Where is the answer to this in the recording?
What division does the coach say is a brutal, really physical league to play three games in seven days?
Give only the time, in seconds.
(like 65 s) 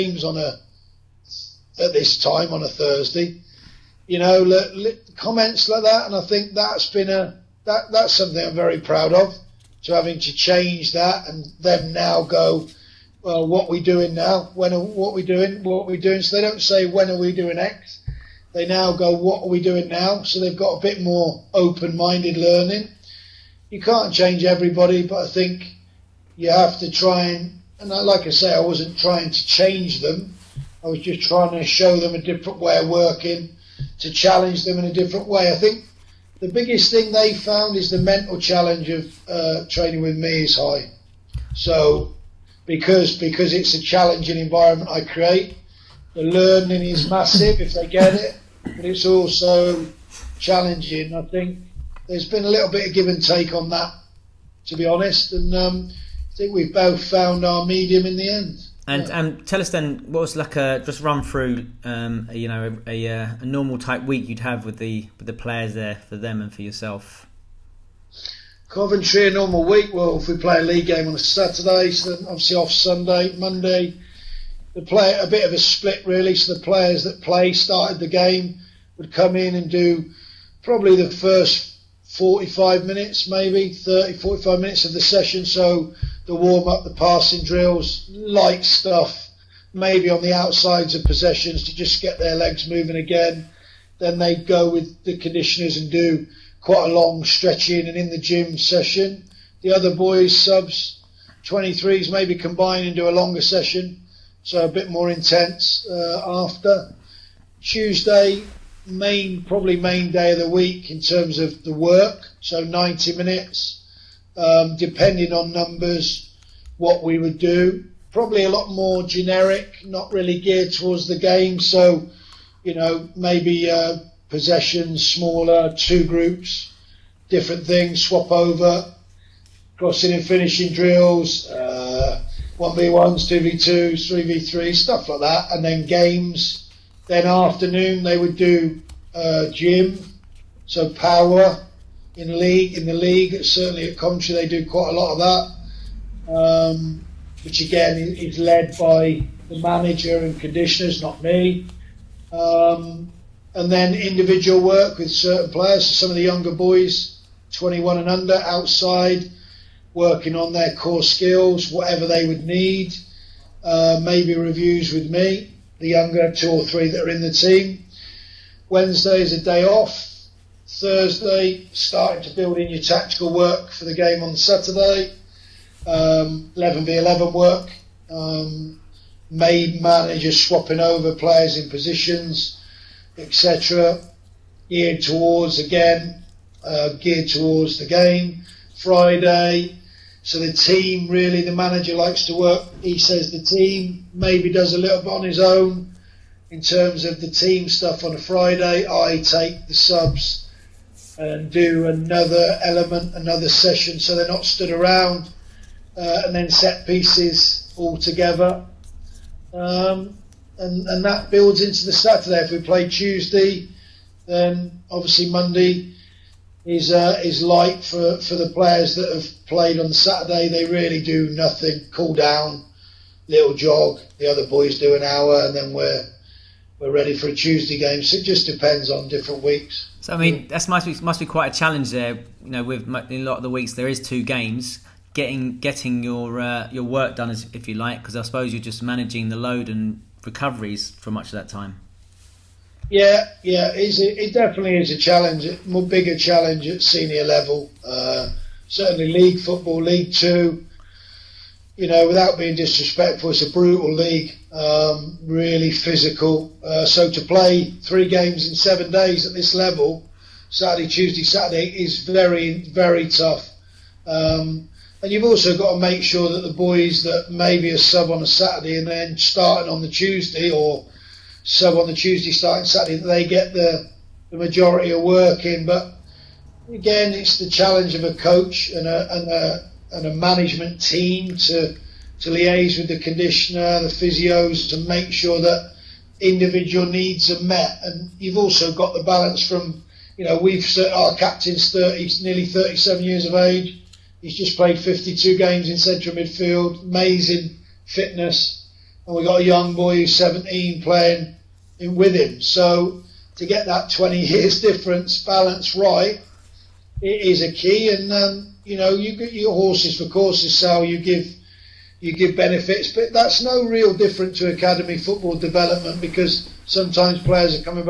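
249 s.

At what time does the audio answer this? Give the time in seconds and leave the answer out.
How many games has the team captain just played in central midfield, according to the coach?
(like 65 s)
294 s.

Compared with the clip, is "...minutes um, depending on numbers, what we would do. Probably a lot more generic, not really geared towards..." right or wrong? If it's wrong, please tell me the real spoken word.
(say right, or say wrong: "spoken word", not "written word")
right.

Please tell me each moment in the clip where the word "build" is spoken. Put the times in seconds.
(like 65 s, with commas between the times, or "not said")
172 s, 211 s.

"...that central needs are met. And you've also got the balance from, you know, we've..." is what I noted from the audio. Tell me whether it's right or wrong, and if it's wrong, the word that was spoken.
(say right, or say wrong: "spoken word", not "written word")
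wrong: "individual", not "central".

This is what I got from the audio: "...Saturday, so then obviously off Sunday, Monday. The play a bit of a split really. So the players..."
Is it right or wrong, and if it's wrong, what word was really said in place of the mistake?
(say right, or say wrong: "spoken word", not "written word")
right.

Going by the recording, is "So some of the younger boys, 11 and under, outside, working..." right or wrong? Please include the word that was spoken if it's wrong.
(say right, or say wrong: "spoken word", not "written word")
wrong: "21", not "11".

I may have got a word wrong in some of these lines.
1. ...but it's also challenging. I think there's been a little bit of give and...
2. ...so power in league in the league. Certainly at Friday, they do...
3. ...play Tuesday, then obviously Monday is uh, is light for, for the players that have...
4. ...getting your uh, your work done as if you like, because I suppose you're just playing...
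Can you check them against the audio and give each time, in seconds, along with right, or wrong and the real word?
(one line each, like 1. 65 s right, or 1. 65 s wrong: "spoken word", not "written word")
1. 48 s right
2. 140 s wrong: "Coventry", not "Friday"
3. 212 s right
4. 235 s wrong: "managing", not "playing".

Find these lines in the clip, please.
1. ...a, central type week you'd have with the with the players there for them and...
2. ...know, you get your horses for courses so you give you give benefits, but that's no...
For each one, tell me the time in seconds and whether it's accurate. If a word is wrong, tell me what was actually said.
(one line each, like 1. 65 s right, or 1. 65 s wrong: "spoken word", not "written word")
1. 63 s wrong: "normal", not "central"
2. 308 s right.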